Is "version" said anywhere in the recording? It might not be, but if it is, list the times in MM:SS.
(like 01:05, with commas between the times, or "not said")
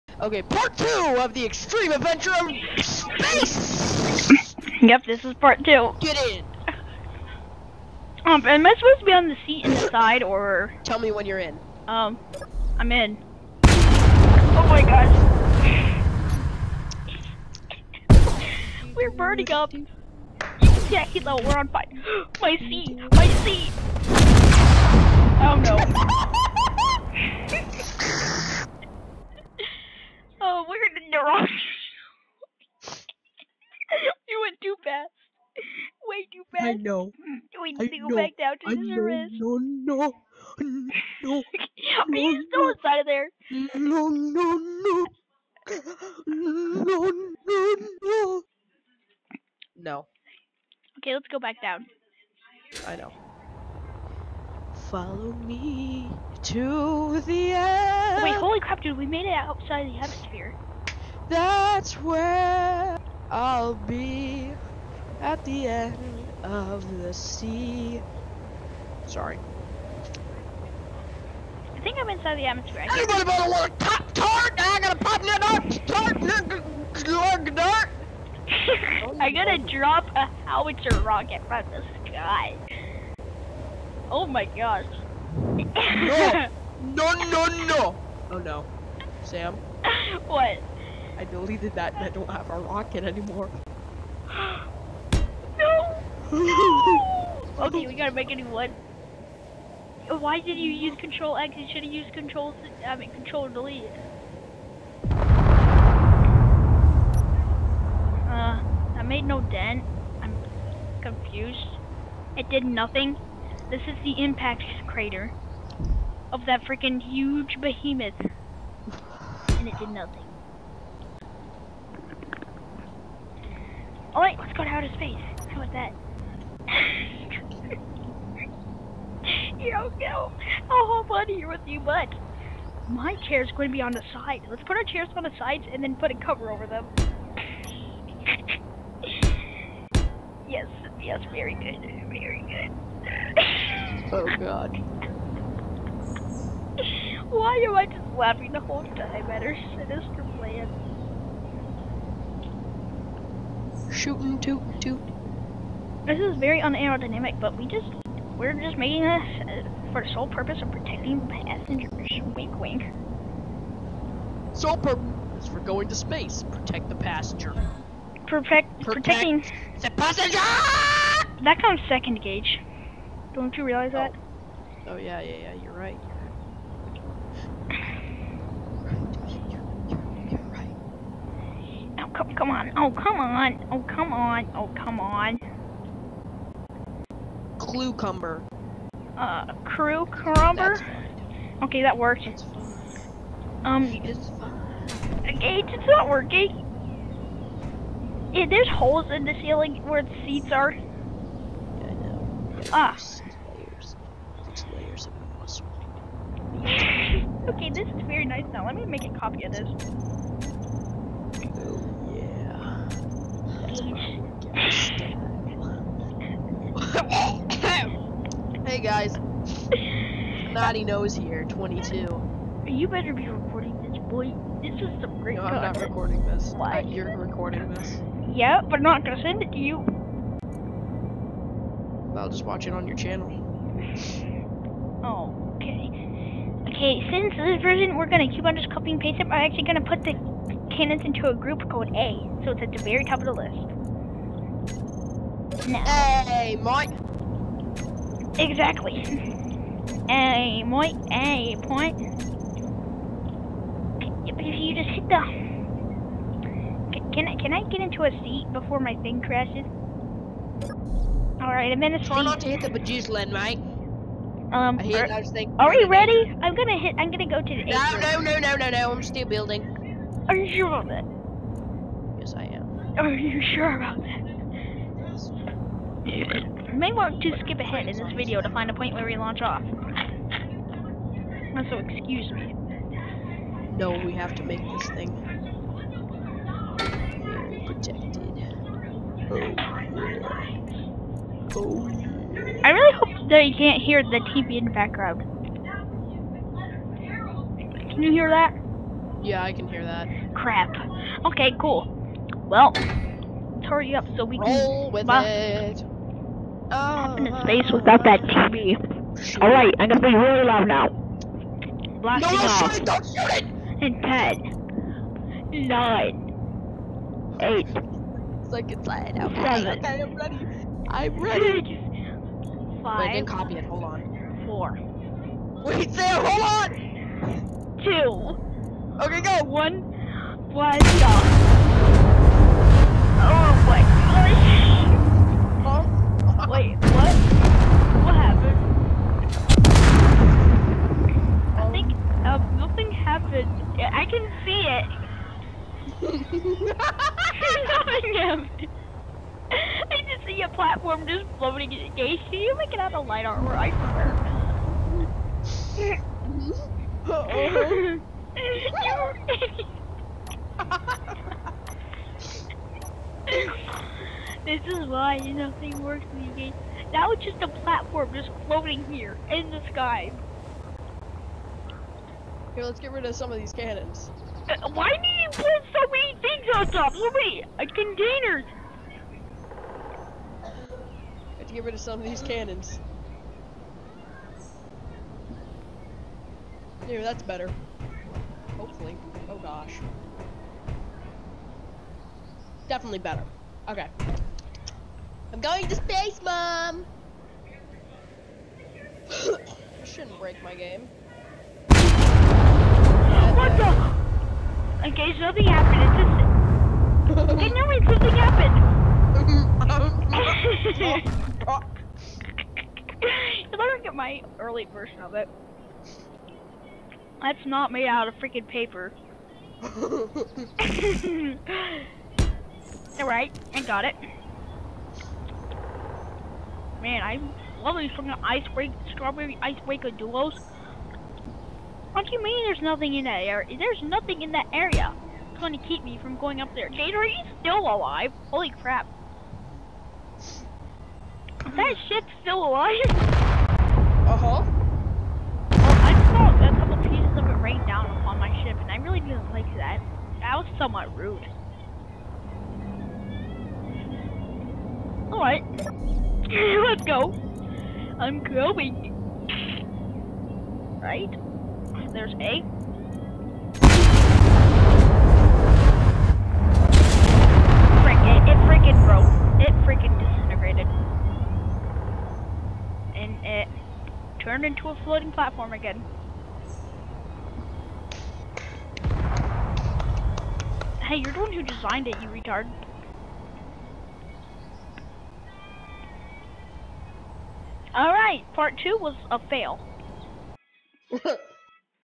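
03:57, 06:54.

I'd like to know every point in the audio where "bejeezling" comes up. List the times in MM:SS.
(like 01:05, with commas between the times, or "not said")
04:22.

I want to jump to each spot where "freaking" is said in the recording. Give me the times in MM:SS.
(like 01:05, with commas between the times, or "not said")
01:56, 06:58.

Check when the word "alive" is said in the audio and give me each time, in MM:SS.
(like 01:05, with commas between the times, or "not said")
07:17, 07:22.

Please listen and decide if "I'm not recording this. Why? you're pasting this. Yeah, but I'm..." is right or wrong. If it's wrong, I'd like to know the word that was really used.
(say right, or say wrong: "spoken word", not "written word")
wrong: "recording", not "pasting".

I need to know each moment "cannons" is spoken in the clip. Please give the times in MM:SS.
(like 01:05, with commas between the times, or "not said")
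04:00, 06:13, 06:22.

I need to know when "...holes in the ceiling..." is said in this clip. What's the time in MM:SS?
03:18.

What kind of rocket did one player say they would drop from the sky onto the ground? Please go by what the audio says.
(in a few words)
howitzer rocket.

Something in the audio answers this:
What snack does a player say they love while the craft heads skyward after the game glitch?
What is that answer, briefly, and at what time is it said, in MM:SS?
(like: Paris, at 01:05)
strawberry ice breaker duos, at 07:08.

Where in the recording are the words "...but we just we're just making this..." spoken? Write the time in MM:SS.
02:37.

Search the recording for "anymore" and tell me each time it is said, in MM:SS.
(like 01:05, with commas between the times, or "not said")
01:33.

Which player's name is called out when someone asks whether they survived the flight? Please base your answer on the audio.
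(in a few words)
Jade.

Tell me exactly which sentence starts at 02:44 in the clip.
Sole purpose is for going to space.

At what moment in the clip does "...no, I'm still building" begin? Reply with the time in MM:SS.
04:28.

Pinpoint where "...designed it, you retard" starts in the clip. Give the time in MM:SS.
08:01.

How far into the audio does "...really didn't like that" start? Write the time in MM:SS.
07:28.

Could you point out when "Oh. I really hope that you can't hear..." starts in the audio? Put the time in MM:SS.
04:49.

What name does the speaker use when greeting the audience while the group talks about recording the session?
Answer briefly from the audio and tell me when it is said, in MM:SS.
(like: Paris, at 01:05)
Naughty Nose, at 03:40.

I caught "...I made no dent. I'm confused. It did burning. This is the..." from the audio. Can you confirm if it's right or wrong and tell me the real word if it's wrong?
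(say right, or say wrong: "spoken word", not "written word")
wrong: "nothing", not "burning".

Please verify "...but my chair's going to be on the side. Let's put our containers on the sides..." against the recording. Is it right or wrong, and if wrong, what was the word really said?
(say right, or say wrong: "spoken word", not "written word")
wrong: "chairs", not "containers".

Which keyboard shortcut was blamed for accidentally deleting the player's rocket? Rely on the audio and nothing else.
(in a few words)
Control X.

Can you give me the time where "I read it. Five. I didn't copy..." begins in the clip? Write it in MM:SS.
05:20.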